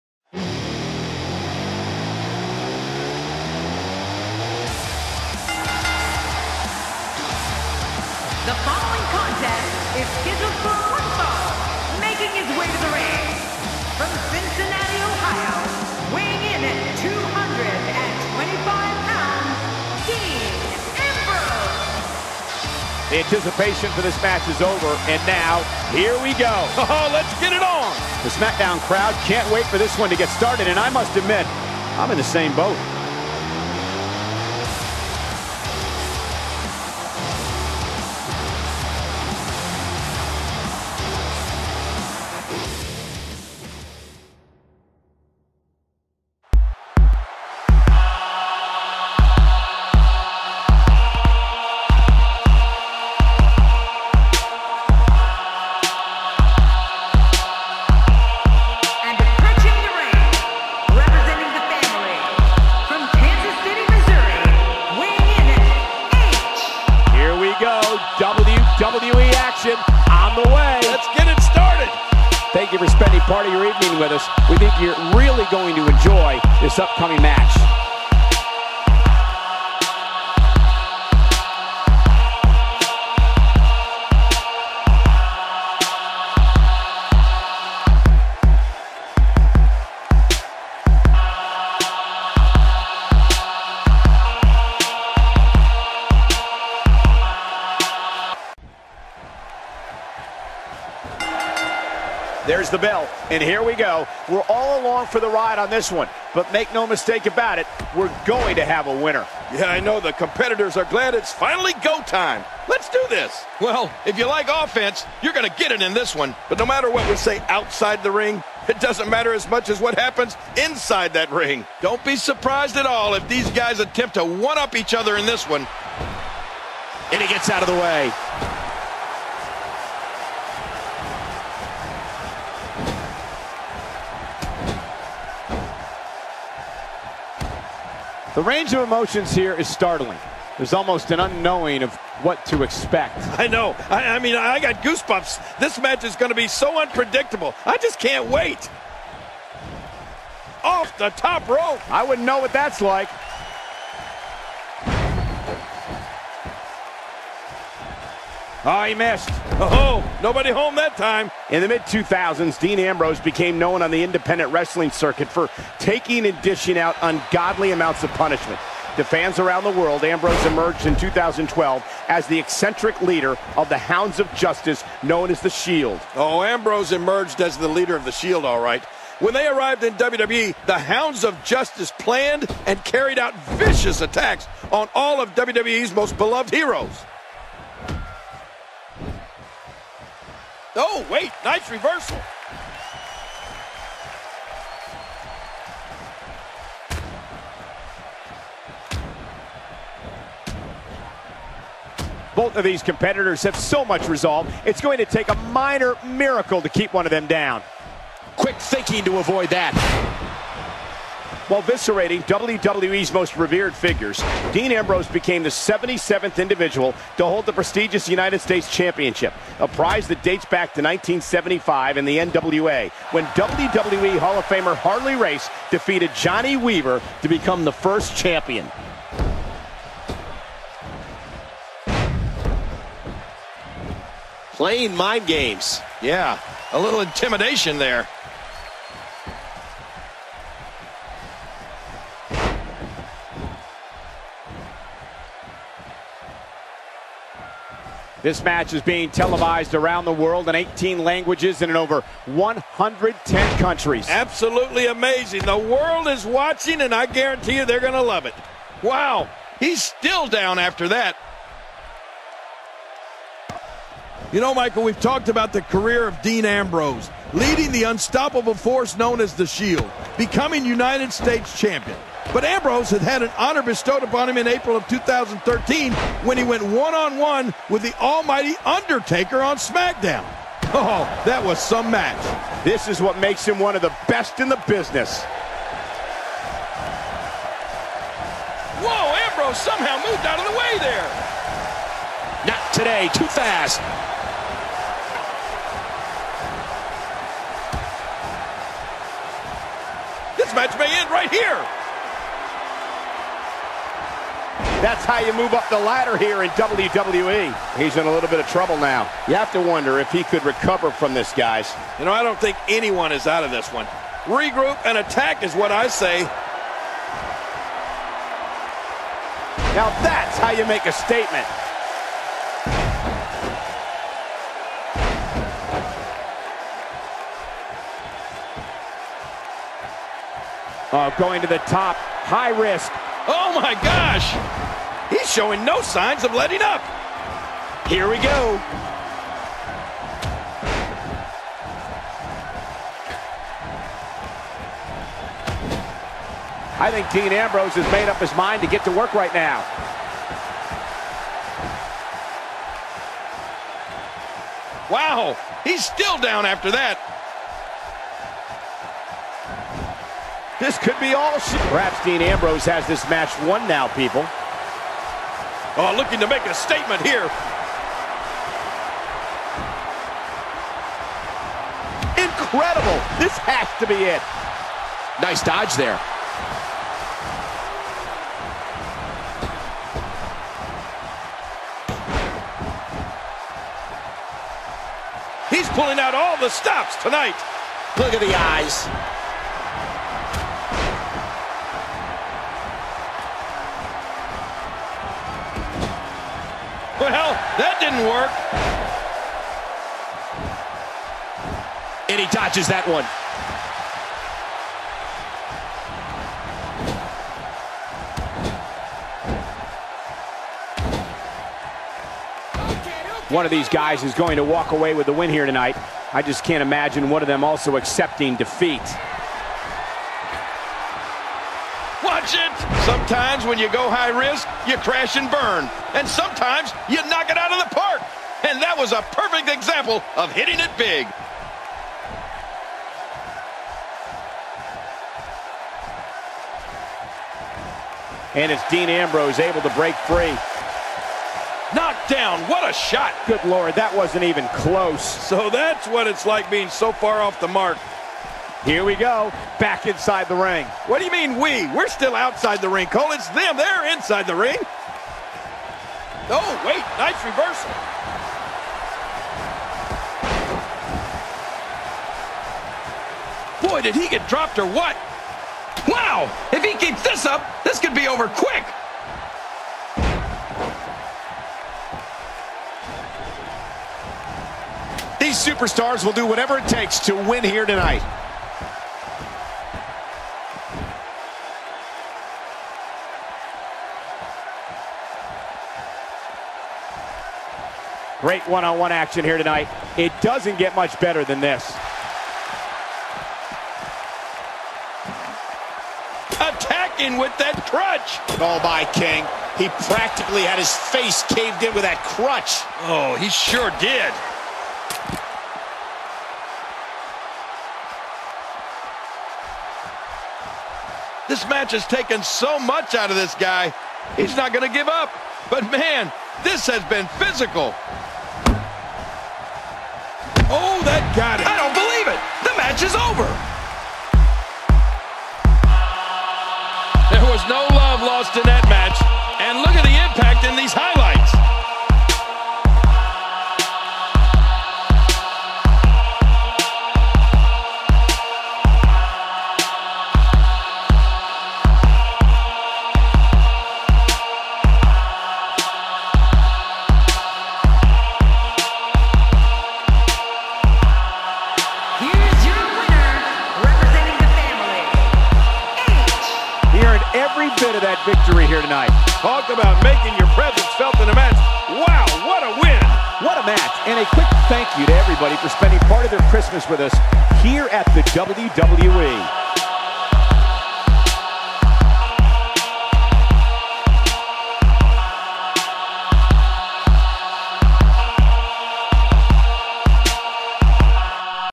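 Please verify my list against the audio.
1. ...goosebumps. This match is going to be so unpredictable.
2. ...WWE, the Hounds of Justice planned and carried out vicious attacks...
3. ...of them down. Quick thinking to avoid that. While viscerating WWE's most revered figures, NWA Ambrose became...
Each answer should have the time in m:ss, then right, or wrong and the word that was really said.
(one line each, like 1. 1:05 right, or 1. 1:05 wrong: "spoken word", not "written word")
1. 2:24 right
2. 2:59 right
3. 3:27 wrong: "Dean", not "NWA".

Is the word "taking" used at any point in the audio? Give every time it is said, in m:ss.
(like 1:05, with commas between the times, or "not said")
2:45.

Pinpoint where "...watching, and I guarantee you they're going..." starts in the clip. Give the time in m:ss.
4:16.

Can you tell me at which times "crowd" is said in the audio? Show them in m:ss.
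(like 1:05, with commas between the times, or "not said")
0:28.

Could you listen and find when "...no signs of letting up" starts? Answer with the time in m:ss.
5:35.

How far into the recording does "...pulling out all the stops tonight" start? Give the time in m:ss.
6:25.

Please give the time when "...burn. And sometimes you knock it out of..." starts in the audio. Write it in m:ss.
7:05.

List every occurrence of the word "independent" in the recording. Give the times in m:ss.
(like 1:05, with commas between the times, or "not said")
2:44.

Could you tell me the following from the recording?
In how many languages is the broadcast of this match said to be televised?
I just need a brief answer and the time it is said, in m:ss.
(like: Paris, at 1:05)
18, at 4:10.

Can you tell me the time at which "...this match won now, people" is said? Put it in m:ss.
6:02.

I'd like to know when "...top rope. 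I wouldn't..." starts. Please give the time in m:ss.
2:31.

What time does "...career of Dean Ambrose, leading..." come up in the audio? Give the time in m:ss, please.
4:25.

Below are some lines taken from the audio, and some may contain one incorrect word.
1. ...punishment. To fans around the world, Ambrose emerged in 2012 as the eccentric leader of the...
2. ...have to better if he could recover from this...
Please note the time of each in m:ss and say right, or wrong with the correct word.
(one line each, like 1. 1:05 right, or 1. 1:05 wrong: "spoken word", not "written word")
1. 2:48 right
2. 5:09 wrong: "wonder", not "better".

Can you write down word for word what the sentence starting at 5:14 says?
Regroup and attack is what I say.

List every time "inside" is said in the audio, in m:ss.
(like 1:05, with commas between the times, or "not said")
2:00, 7:29, 7:33.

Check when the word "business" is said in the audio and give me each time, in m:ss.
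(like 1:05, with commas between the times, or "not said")
4:44.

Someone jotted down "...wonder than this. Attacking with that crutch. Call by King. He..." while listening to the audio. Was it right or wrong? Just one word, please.
wrong.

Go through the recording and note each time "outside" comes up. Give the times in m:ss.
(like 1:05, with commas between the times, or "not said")
1:57, 7:32.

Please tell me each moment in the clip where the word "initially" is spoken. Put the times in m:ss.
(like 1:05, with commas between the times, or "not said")
not said.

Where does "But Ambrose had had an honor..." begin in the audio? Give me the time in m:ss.
4:32.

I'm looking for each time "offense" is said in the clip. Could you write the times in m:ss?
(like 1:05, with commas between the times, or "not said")
1:54.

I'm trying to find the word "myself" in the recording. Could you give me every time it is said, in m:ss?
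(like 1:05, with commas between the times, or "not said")
not said.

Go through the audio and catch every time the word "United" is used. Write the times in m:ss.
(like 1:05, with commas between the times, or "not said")
3:38, 4:30.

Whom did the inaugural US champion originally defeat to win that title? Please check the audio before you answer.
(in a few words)
Johnny Weaver.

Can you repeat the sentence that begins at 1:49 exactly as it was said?
Yeah, I know the competitors are glad it's finally go time.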